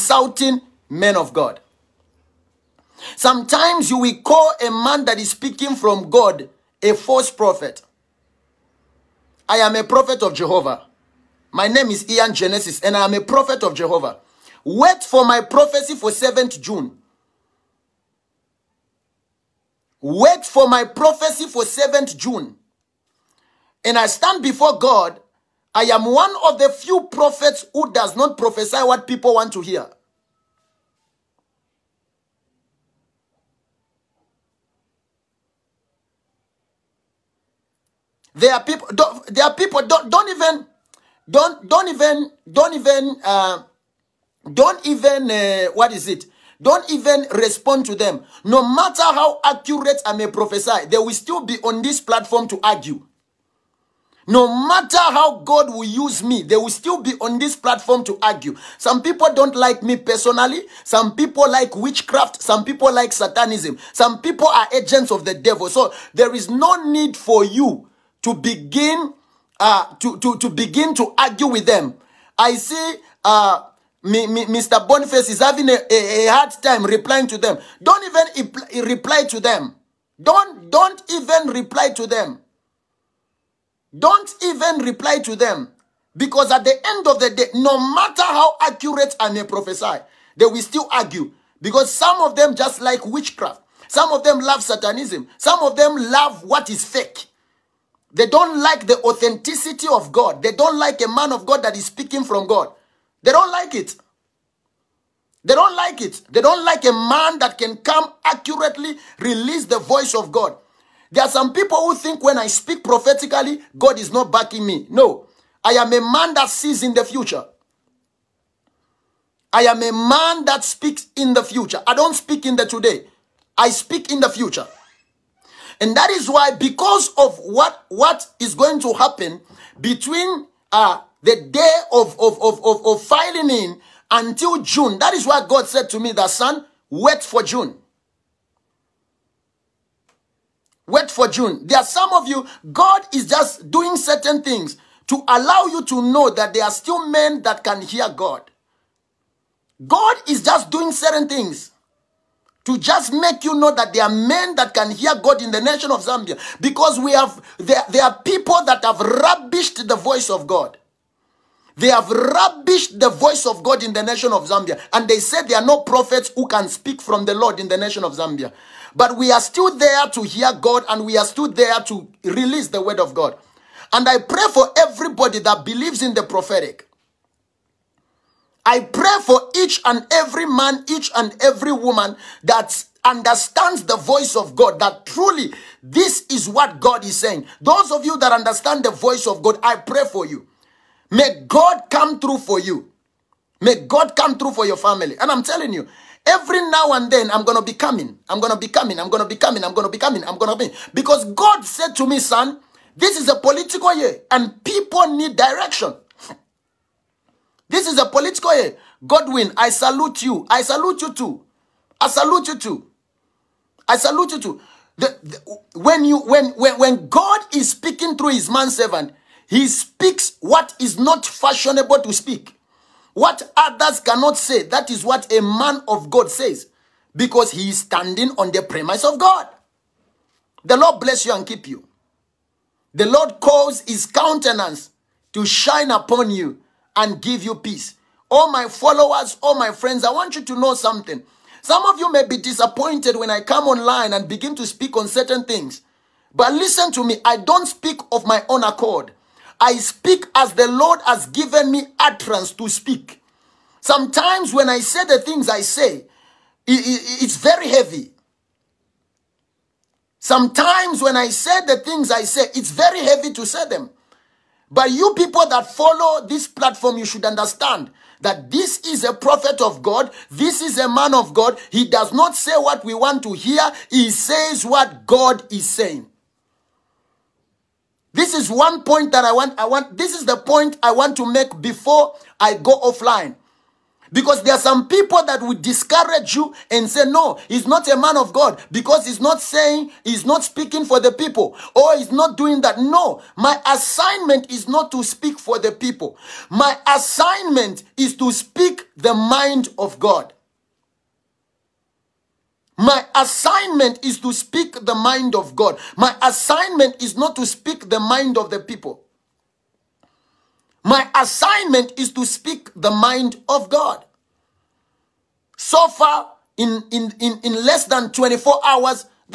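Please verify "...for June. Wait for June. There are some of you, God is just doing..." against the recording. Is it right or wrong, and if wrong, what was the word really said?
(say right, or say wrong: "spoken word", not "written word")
right.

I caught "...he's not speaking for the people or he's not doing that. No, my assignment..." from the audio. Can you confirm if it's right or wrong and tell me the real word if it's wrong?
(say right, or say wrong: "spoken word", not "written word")
right.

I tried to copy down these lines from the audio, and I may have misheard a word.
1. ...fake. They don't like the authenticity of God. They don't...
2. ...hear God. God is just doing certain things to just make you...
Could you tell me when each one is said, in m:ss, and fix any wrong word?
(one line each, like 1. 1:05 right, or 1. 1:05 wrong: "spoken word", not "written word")
1. 1:36 right
2. 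2:27 right.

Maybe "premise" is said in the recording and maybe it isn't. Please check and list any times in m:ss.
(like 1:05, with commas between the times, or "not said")
3:48.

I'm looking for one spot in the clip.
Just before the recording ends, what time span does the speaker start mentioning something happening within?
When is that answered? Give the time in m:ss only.
5:17.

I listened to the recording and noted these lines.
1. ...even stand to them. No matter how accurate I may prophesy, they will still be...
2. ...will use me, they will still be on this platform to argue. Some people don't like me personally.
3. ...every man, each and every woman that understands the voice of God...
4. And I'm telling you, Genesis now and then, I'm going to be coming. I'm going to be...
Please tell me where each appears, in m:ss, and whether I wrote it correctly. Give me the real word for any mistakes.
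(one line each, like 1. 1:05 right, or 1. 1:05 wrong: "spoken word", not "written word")
1. 0:46 wrong: "respond", not "stand"
2. 0:55 right
3. 3:00 right
4. 3:15 wrong: "Every", not "Genesis".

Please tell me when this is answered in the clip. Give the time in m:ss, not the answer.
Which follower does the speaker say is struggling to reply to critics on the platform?
1:14.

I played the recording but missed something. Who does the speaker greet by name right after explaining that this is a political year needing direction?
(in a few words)
Godwin.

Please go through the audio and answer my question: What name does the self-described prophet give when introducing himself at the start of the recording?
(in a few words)
Ian Genesis.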